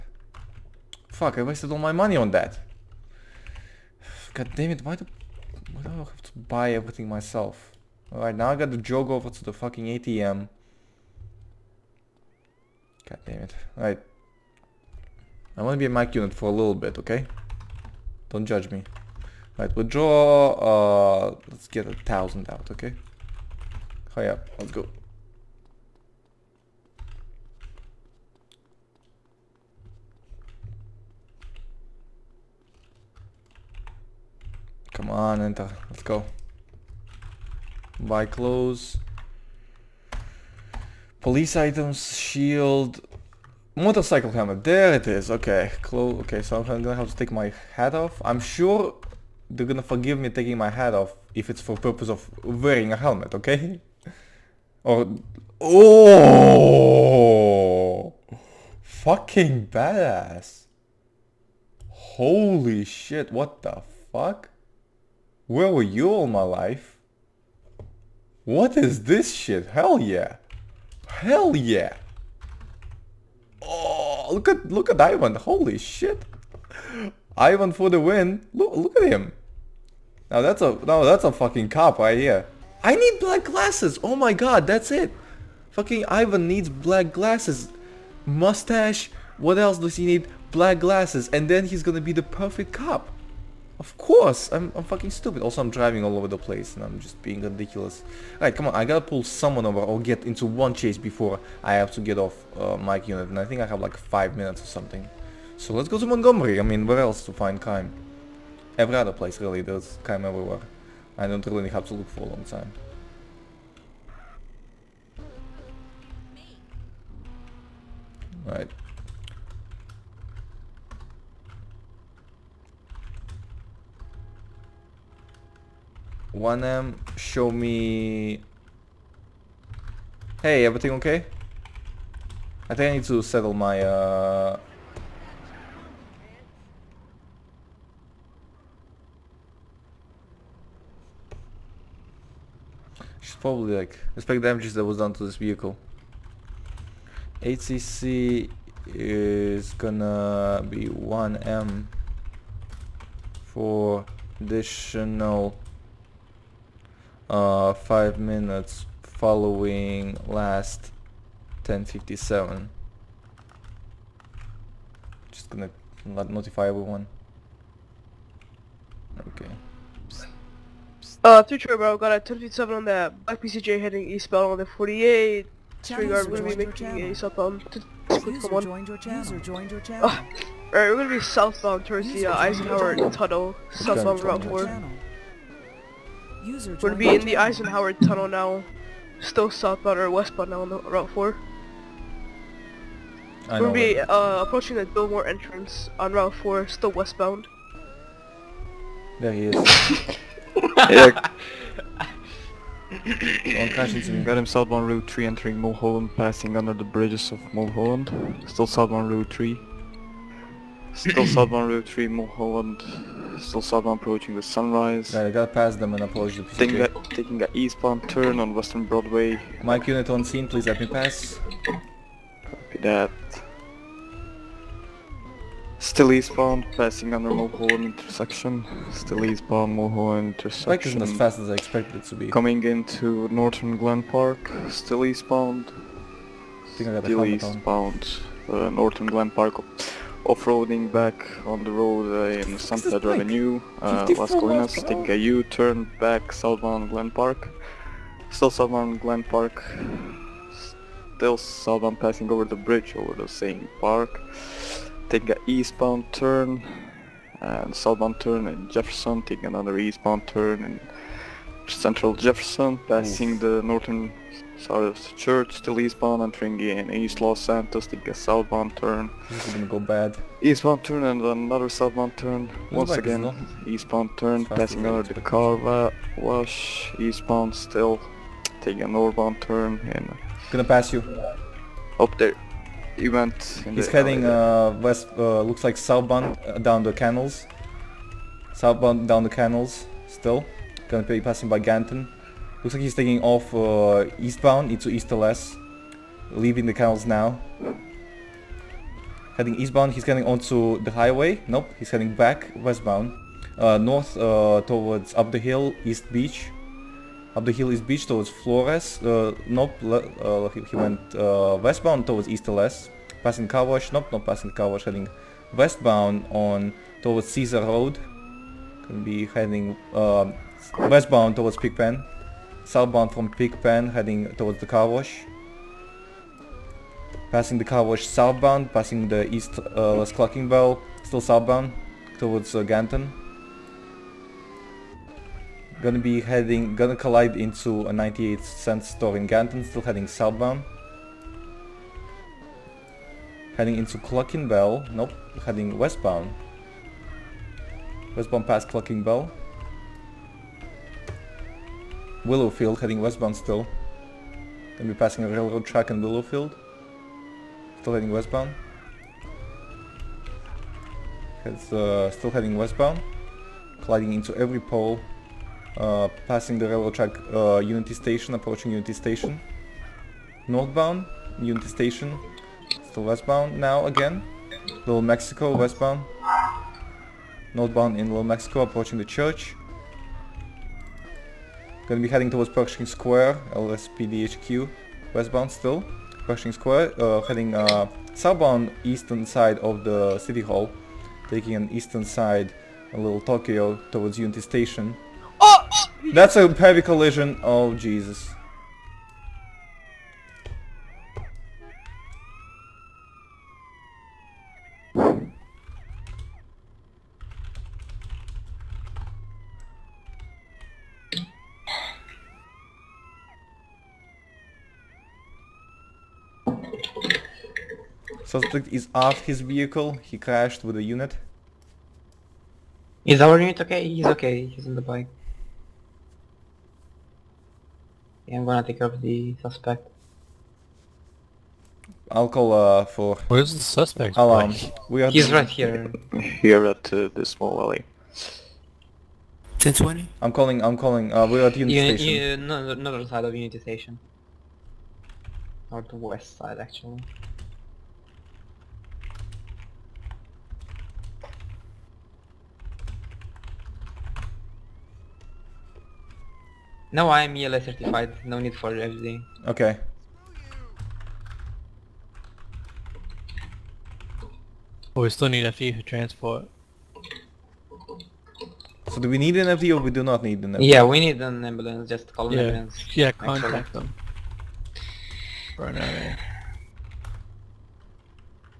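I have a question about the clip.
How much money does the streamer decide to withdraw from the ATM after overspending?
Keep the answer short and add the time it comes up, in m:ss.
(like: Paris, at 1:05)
1000, at 0:21.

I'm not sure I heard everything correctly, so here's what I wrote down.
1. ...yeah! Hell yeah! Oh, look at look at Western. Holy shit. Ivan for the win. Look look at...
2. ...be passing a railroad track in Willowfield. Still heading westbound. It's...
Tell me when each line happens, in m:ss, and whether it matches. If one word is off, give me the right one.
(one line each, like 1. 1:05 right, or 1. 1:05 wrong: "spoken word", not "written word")
1. 1:09 wrong: "Ivan", not "Western"
2. 5:54 right.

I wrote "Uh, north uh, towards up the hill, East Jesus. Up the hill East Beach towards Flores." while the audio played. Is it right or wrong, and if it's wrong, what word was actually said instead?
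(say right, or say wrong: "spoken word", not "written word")
wrong: "Beach", not "Jesus".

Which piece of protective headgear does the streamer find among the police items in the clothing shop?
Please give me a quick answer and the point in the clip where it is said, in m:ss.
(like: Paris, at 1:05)
Motorcycle helmet, at 0:43.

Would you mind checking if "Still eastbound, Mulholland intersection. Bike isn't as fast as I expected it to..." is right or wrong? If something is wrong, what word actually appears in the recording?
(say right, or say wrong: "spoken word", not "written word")
right.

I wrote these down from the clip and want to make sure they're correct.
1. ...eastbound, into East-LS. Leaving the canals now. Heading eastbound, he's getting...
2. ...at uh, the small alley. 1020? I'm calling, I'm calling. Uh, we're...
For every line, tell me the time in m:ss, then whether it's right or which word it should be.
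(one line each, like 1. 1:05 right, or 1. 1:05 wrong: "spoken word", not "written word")
1. 4:54 right
2. 7:16 right.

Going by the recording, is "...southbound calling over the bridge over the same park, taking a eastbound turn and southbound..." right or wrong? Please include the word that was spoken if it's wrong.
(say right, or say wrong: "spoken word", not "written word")
wrong: "passing", not "calling".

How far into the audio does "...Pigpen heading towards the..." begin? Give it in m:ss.
5:23.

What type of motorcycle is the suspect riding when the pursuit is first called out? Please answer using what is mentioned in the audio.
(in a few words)
Black PCJ.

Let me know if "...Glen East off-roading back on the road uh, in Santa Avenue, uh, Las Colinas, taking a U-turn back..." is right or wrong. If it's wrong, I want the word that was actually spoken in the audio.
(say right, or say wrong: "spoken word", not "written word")
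wrong: "Park", not "East".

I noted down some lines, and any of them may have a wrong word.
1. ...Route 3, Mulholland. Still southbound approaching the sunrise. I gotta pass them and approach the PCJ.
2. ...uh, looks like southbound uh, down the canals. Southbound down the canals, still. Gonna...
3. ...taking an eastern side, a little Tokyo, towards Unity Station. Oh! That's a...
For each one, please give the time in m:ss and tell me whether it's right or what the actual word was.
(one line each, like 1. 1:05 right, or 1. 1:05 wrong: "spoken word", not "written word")
1. 3:31 right
2. 4:45 right
3. 6:31 right.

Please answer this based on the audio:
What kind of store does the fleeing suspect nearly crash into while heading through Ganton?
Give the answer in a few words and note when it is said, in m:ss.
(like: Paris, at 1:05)
98 cent store, at 5:37.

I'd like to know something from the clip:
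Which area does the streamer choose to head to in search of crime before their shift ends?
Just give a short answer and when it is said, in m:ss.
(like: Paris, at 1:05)
Montgomery, at 1:46.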